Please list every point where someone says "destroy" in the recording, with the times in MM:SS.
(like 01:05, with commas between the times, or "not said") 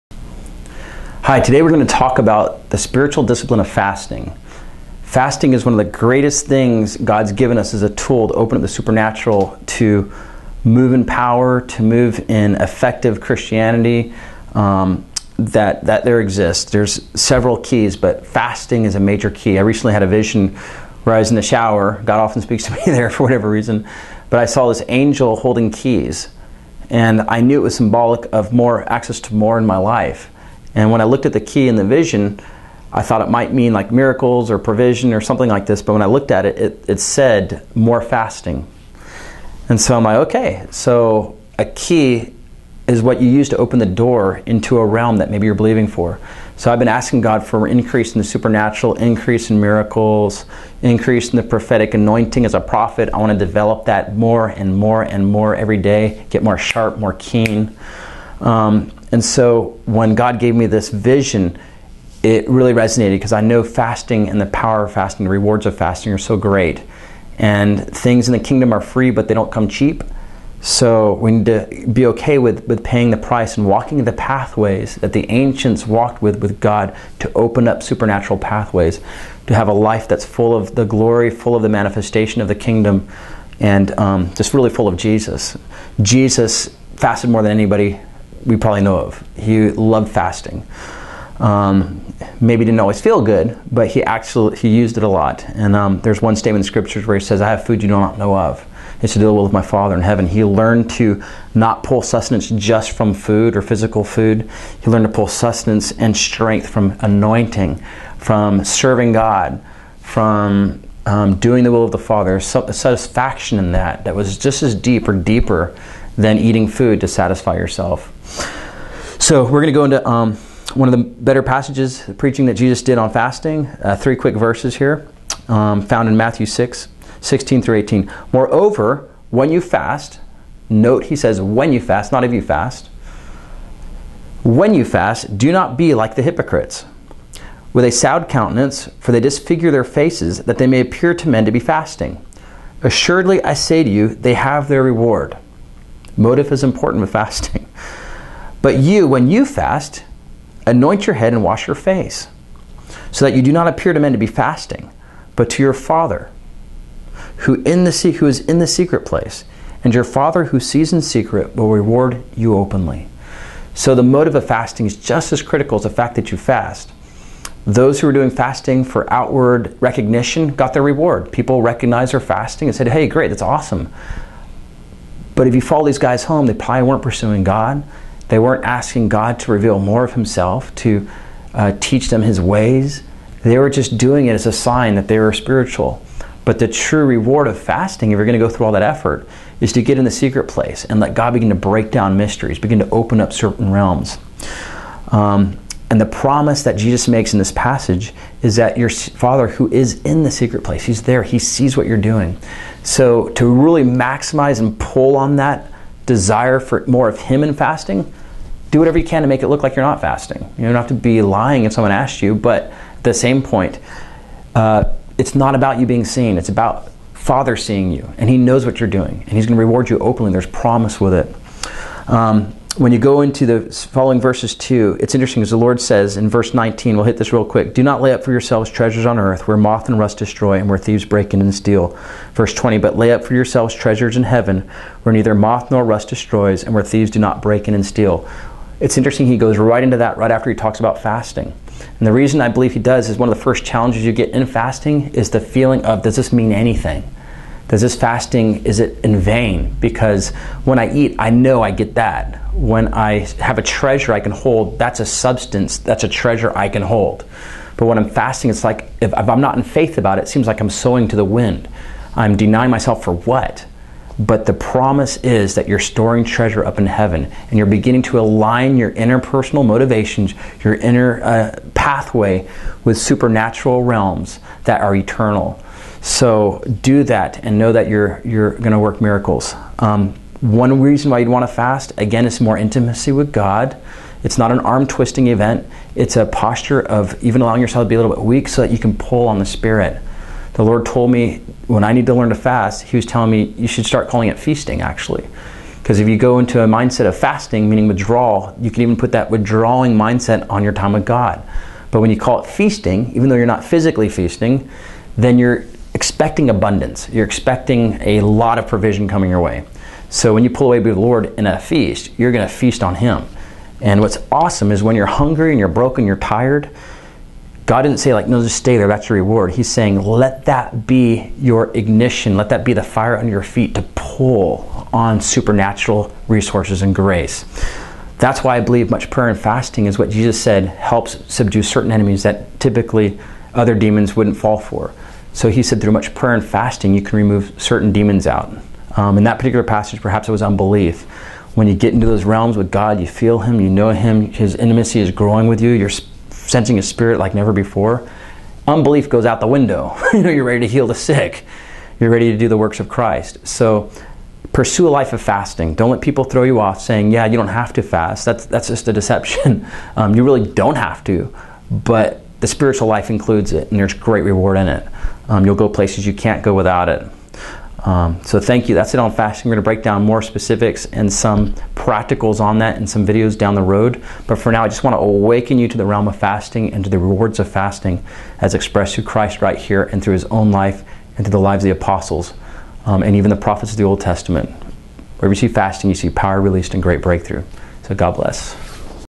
03:50, 03:56.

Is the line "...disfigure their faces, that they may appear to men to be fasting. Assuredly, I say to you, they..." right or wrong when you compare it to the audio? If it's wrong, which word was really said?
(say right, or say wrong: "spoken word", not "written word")
right.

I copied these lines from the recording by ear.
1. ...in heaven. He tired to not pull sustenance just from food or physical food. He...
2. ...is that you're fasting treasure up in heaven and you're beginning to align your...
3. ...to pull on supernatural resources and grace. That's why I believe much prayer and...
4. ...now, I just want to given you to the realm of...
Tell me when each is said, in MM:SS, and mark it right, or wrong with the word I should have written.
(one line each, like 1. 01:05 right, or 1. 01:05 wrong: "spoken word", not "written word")
1. 01:39 wrong: "learned", not "tired"
2. 04:25 wrong: "storing", not "fasting"
3. 05:23 right
4. 06:14 wrong: "awaken", not "given".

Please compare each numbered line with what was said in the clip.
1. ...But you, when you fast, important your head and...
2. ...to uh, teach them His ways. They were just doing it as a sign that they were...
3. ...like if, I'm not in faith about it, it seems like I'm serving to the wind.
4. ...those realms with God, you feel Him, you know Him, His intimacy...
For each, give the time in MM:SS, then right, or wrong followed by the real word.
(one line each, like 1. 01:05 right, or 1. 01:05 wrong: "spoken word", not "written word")
1. 02:28 wrong: "anoint", not "important"
2. 03:00 right
3. 04:18 wrong: "sowing", not "serving"
4. 05:42 right.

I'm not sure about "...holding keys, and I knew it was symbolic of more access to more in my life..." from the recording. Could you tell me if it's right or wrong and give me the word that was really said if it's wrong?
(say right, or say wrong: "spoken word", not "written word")
right.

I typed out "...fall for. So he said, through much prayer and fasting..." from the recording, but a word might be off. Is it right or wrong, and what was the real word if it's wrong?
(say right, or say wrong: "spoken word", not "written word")
right.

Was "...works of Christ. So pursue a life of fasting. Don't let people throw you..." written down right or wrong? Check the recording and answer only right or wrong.
right.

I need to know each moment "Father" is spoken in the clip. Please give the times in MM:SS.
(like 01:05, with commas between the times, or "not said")
01:39, 01:51, 02:35, 02:40, 03:18, 03:37.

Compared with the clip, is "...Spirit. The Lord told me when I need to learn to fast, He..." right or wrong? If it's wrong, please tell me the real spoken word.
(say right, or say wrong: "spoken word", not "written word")
right.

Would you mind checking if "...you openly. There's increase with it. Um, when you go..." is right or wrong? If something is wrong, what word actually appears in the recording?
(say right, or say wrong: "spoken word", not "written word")
wrong: "promise", not "increase".